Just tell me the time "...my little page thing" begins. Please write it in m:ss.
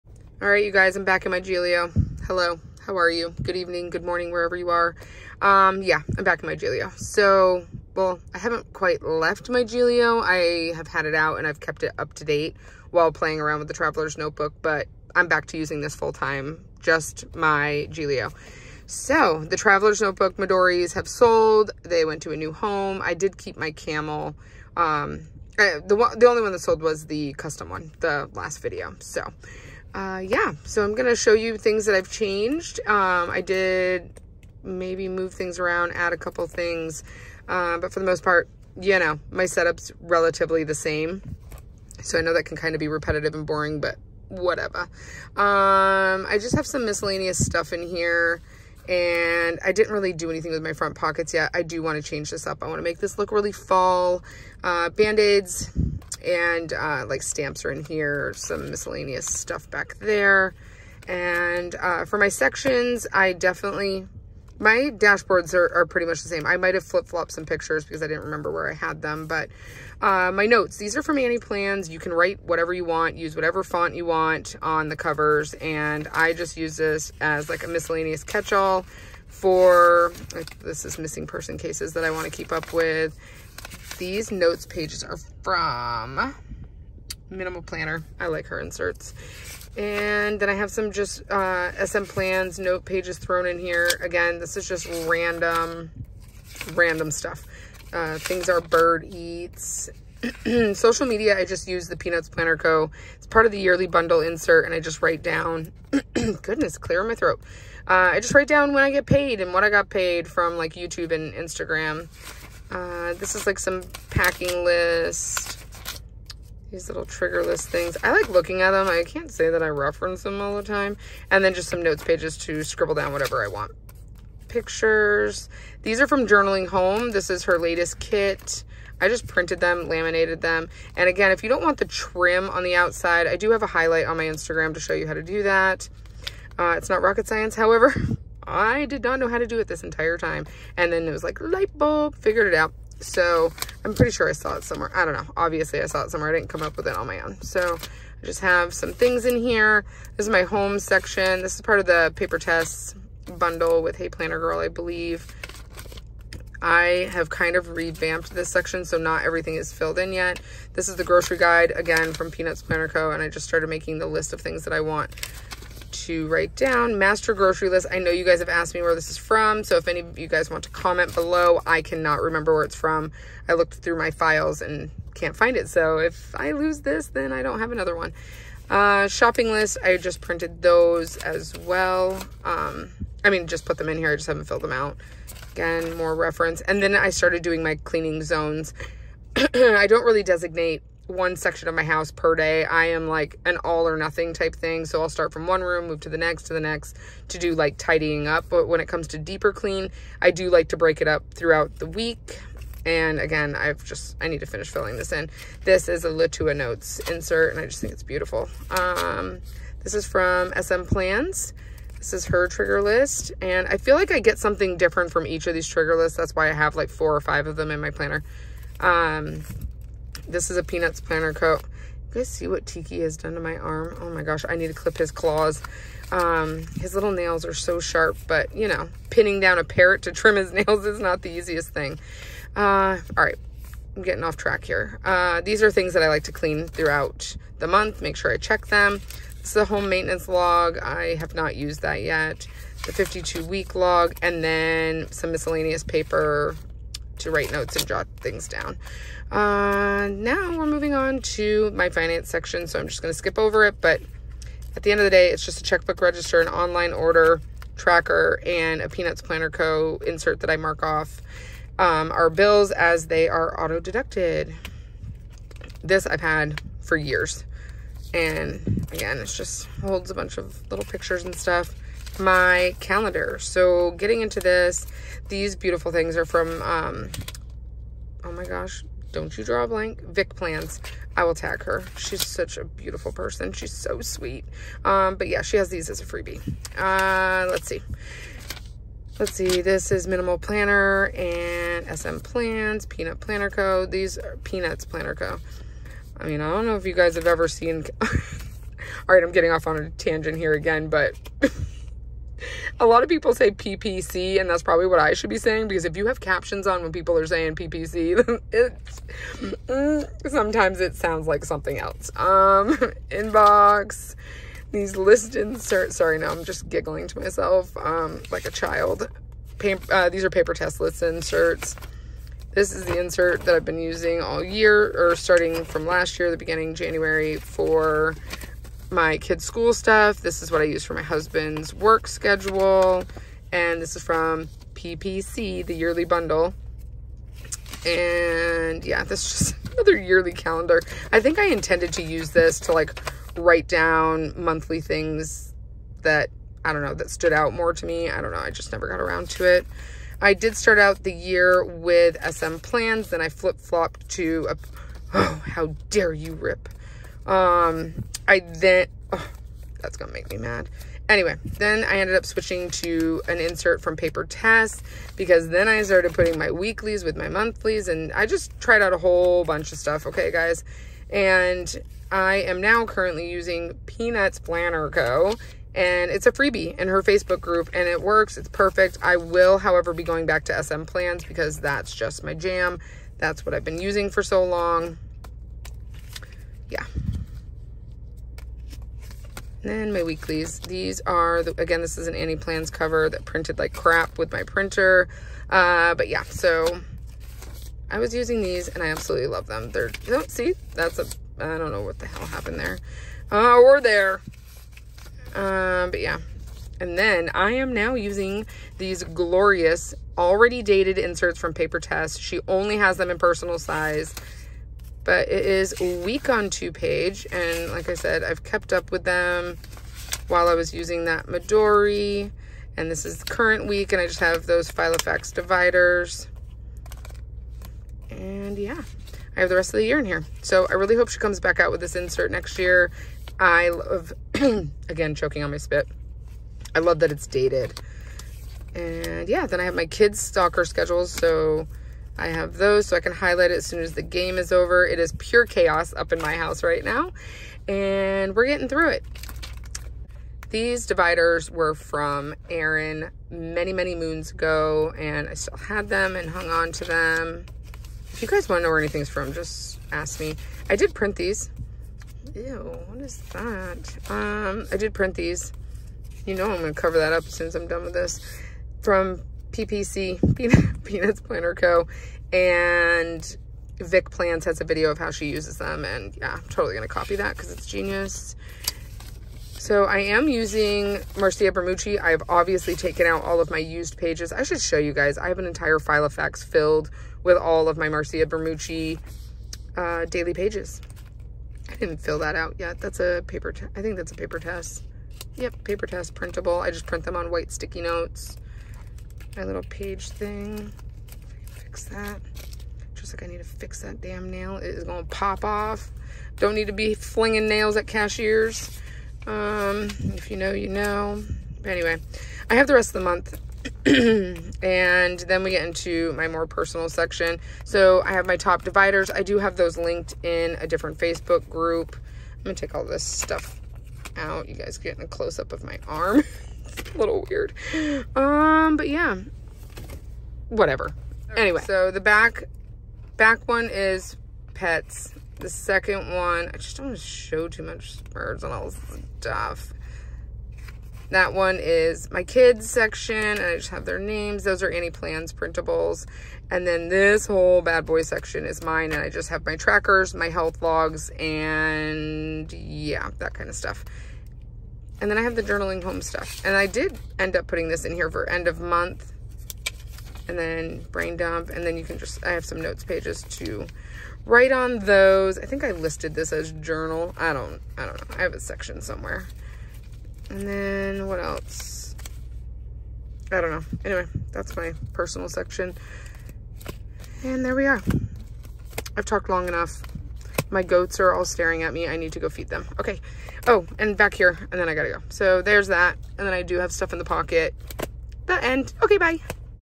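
8:19.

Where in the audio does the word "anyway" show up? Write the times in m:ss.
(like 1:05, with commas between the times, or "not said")
6:01, 8:31, 8:51, 9:33.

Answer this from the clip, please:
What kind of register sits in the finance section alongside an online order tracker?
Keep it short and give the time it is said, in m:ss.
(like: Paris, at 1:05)
Checkbook register, at 4:15.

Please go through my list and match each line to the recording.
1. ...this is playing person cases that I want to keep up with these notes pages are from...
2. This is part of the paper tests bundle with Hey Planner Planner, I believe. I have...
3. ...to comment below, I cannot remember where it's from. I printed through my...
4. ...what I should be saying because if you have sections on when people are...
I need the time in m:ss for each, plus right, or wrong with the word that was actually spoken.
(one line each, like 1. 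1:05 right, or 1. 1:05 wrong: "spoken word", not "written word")
1. 1:20 wrong: "missing", not "playing"
2. 2:31 wrong: "Girl", not "Planner"
3. 2:50 wrong: "looked", not "printed"
4. 5:04 wrong: "captions", not "sections".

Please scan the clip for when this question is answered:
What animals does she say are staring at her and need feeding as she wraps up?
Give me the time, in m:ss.
9:40.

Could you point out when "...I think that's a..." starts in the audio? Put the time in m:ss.
8:13.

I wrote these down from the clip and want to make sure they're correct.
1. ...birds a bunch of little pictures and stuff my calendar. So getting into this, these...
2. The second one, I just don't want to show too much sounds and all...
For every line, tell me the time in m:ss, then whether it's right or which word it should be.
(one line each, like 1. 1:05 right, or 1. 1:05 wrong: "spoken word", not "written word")
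1. 4:29 wrong: "holds", not "birds"
2. 8:55 wrong: "birds", not "sounds".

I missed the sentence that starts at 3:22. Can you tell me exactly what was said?
And again, I've just, I need to finish filling this in.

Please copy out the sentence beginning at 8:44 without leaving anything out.
You guys getting a close-up of my arm.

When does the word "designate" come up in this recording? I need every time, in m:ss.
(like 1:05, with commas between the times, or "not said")
3:10.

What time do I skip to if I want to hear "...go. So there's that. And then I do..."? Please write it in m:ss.
9:44.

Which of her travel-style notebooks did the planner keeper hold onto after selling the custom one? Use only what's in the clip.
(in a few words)
Camel.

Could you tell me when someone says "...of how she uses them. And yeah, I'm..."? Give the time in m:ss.
7:54.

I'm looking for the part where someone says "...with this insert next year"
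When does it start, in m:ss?
7:11.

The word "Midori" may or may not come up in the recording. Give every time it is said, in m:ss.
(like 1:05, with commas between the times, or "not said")
0:20, 7:01.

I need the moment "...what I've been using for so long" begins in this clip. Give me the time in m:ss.
6:23.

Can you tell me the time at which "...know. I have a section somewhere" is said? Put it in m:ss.
9:28.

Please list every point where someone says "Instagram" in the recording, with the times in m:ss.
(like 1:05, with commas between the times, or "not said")
1:51, 2:14.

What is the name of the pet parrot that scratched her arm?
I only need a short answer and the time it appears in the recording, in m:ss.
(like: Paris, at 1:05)
Tiki, at 3:42.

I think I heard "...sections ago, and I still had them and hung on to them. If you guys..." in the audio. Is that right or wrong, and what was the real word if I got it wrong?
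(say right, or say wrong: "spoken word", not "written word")
wrong: "moons", not "sections".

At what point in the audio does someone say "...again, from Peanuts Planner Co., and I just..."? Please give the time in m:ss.
2:41.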